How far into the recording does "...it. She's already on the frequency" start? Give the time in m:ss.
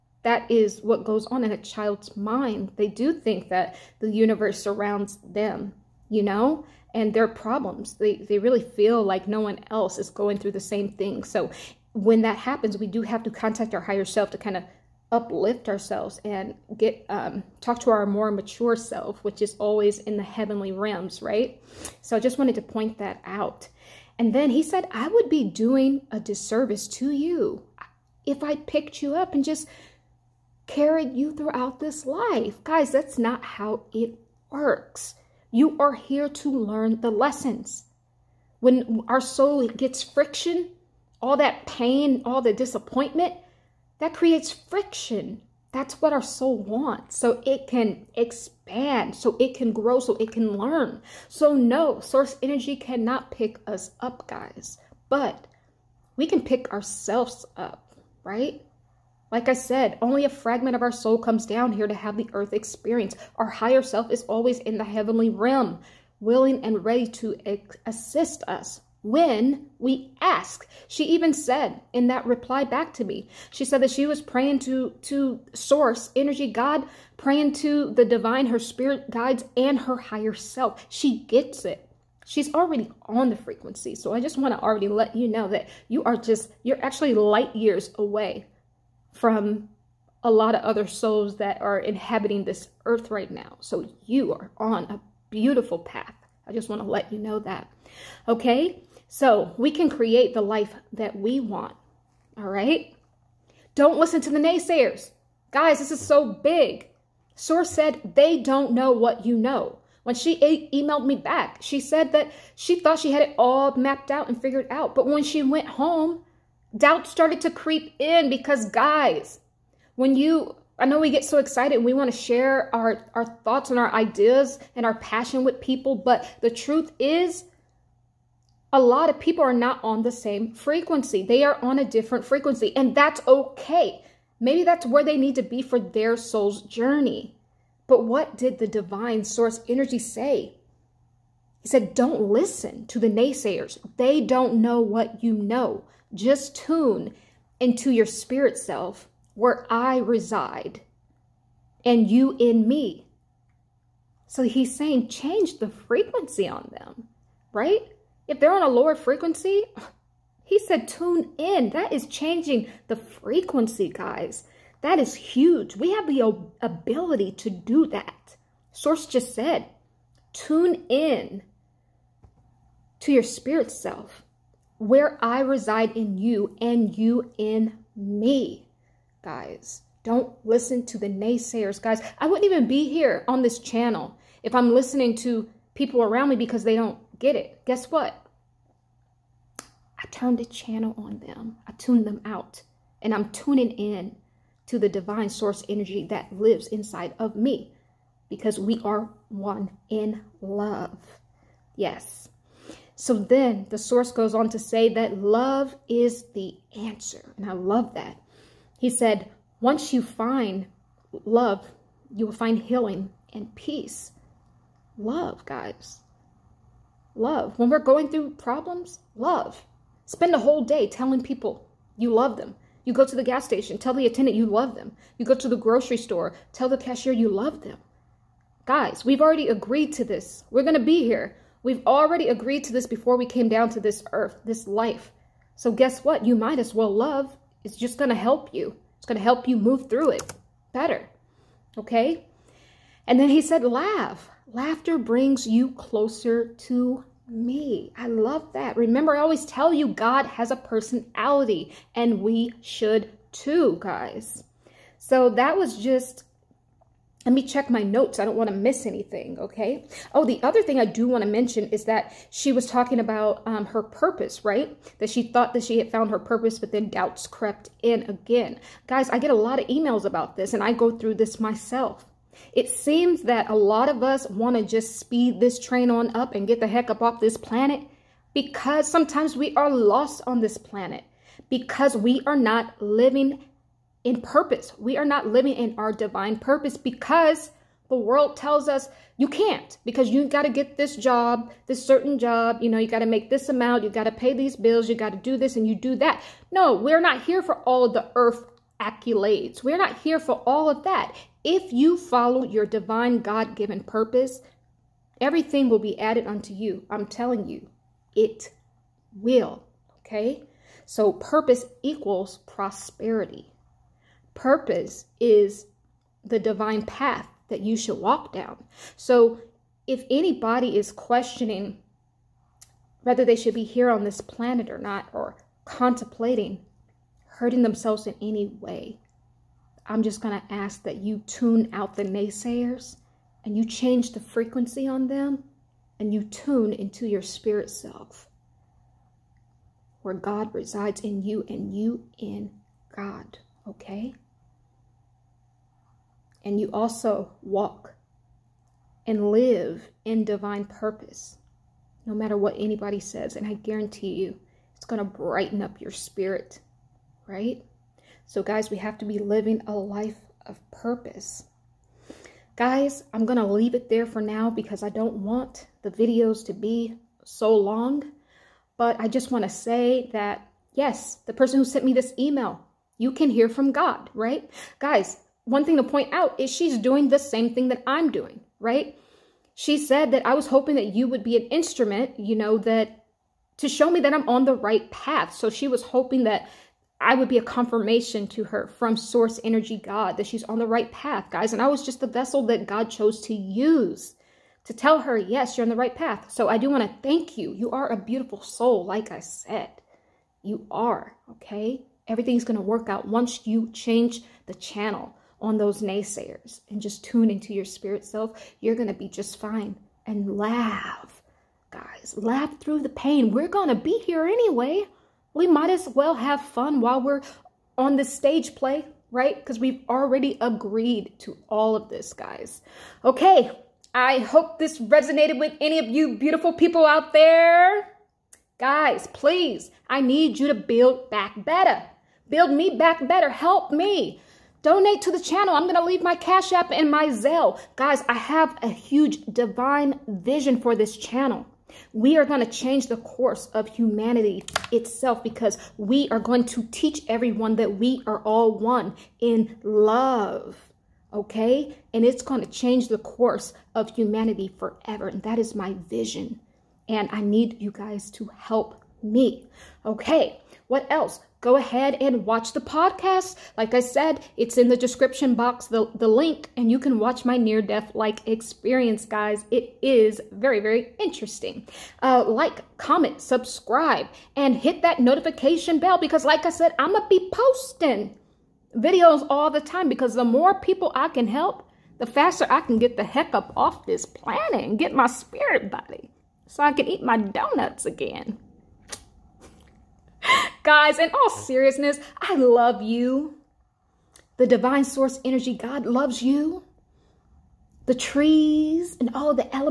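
1:21.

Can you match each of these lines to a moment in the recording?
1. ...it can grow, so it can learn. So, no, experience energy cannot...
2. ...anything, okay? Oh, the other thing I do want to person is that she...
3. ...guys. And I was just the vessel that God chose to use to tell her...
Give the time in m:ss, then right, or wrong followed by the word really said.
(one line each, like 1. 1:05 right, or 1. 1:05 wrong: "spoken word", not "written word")
1. 0:49 wrong: "source", not "experience"
2. 4:18 wrong: "mention", not "person"
3. 6:31 right.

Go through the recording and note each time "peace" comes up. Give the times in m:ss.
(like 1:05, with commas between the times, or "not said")
3:33.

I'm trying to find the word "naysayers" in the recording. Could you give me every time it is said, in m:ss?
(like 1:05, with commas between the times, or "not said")
1:44, 2:23, 3:01, 5:32, 6:45.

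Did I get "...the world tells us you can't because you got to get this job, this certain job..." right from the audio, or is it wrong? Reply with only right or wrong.
right.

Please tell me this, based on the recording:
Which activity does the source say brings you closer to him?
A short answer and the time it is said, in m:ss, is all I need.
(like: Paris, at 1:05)
Laughter, at 4:04.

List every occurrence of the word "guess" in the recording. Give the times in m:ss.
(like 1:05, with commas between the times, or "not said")
3:07, 3:55.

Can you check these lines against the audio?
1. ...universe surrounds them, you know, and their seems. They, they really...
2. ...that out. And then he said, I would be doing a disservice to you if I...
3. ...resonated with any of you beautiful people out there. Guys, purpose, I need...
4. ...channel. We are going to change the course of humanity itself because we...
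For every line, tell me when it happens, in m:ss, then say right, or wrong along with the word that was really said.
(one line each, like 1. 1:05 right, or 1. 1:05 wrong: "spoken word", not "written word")
1. 0:04 wrong: "problems", not "seems"
2. 0:22 right
3. 7:04 wrong: "please", not "purpose"
4. 7:20 right.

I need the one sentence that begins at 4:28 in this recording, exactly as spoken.
Guys, I get a lot of emails about this, and I go through this myself.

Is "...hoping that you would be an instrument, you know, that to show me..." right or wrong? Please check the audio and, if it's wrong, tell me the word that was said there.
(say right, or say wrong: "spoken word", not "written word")
right.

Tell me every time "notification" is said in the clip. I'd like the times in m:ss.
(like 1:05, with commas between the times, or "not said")
7:55.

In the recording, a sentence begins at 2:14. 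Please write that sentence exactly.
Maybe that's where they need to be for their soul's journey.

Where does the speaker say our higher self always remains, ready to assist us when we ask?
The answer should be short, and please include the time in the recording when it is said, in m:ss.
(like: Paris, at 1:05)
The heavenly realm, at 1:04.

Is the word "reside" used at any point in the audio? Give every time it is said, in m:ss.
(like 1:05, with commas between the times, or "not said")
2:29, 2:55, 5:40.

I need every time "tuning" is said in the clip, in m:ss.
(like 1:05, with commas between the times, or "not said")
3:13.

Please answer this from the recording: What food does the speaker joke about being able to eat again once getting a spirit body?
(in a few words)
Donuts.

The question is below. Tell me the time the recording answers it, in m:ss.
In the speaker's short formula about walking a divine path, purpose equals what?
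5:11.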